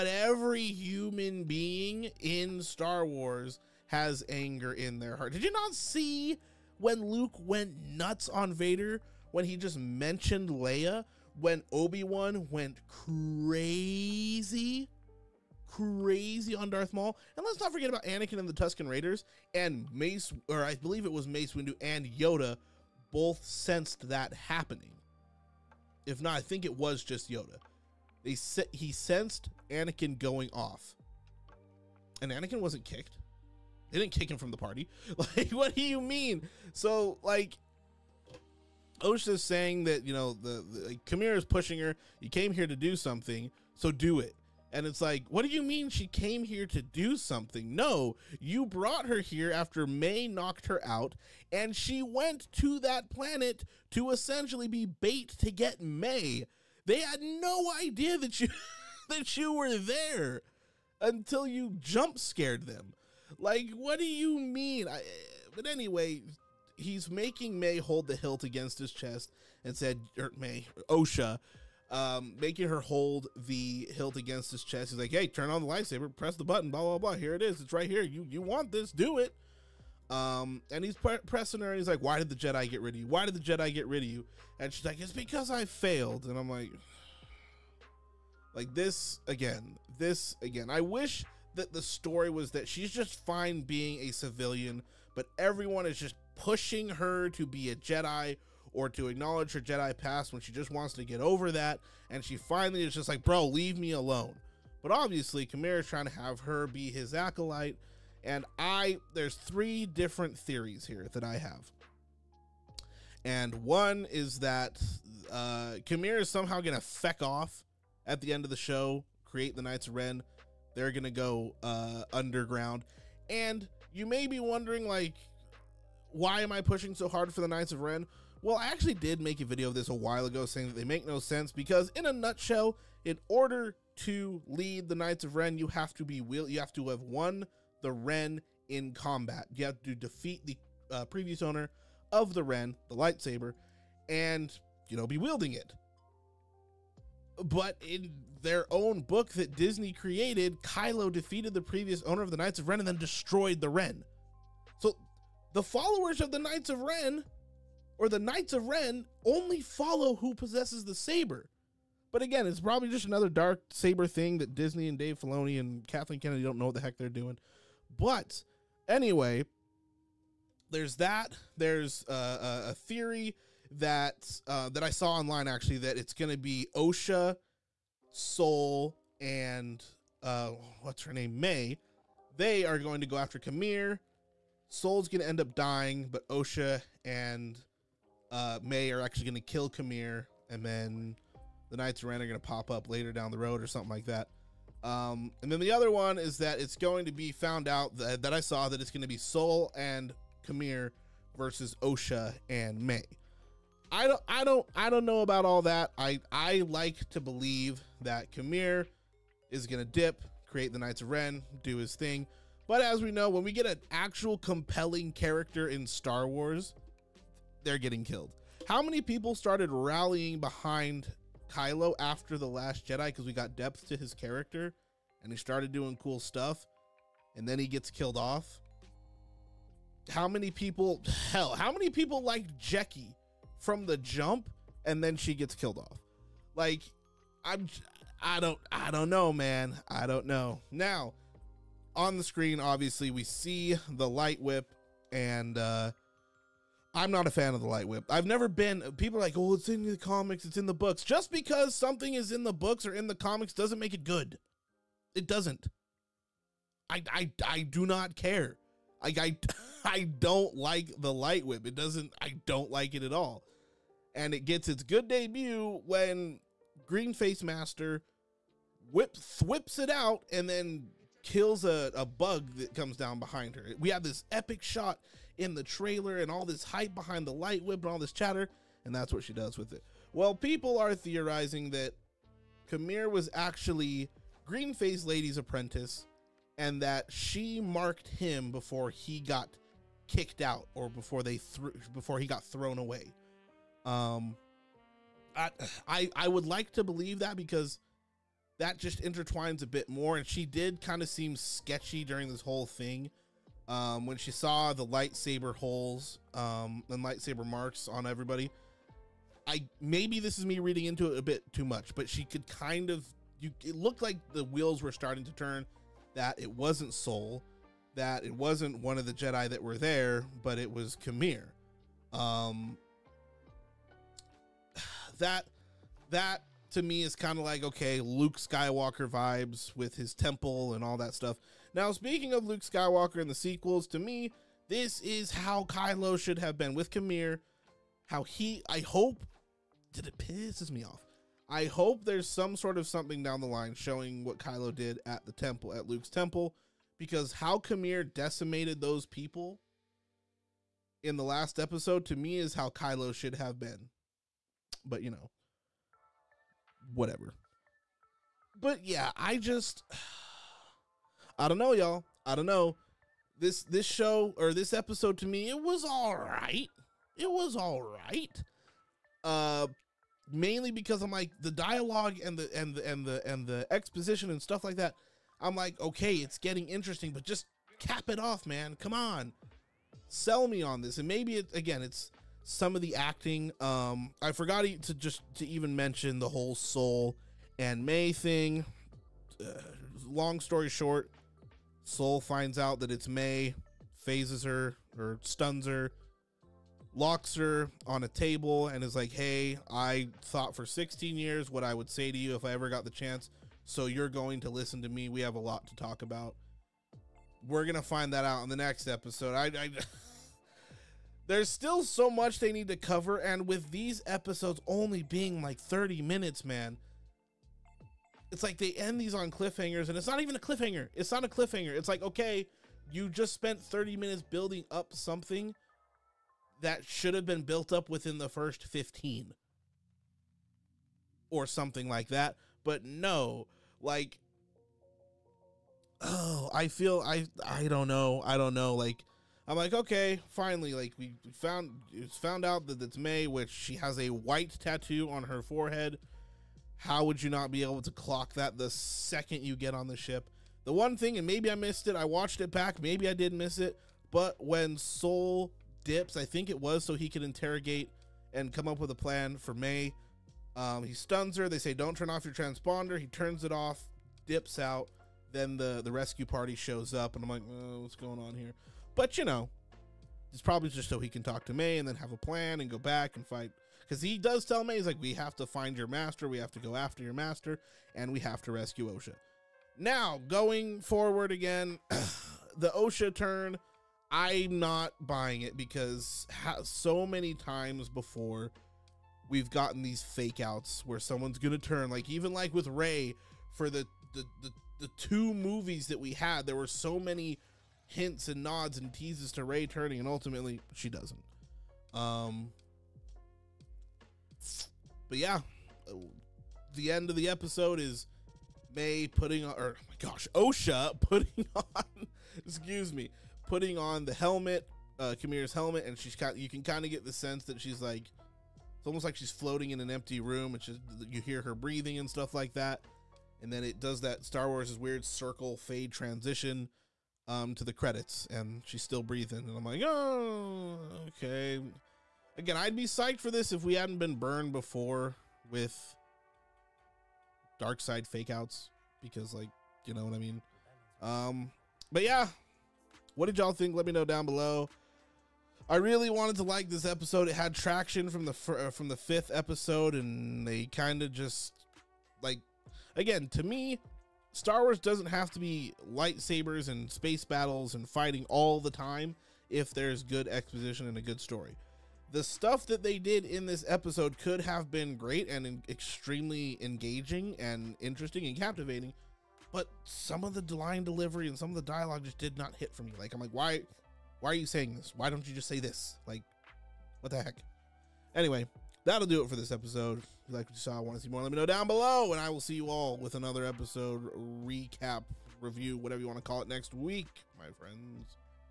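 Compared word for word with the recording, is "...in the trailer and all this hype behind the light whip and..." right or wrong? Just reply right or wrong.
right.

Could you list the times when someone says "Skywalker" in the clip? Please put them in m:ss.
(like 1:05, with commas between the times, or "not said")
5:28, 5:32.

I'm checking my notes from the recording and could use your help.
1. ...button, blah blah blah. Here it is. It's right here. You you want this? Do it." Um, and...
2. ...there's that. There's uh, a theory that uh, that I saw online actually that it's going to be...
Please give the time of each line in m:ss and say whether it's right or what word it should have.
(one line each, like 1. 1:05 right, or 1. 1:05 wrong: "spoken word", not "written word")
1. 1:16 right
2. 2:50 right.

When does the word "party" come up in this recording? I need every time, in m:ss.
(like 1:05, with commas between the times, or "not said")
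0:34, 7:46.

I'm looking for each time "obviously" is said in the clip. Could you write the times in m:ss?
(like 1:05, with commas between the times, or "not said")
1:44, 4:02.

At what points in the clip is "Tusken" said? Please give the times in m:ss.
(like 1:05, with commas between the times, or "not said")
0:18.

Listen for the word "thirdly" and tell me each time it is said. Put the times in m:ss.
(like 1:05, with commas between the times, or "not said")
not said.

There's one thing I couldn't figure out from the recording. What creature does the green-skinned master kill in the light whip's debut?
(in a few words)
A bug.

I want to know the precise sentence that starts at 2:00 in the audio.
They're going to go uh, underground.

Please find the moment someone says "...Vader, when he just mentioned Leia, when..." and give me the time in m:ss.
0:08.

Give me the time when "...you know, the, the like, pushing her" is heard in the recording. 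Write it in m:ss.
0:40.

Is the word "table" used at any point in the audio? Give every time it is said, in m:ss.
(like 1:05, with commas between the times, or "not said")
6:38.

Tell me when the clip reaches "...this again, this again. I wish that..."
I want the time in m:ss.
1:28.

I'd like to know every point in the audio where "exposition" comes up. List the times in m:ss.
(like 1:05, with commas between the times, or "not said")
6:13, 9:20.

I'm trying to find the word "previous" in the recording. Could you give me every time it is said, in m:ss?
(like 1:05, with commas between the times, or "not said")
2:21, 2:31.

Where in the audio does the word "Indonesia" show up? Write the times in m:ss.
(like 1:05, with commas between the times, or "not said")
not said.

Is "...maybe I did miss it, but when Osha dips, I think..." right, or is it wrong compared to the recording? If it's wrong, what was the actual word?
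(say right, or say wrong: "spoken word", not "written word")
wrong: "Sol", not "Osha".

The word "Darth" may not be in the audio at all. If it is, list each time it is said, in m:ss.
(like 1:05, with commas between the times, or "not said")
0:16.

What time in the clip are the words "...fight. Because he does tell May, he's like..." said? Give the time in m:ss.
7:53.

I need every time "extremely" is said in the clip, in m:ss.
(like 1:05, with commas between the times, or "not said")
9:25.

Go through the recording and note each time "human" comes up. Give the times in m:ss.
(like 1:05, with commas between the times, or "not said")
0:00.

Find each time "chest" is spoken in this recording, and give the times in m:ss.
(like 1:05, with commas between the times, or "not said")
1:08, 1:14.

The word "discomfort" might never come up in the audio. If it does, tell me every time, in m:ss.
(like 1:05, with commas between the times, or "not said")
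not said.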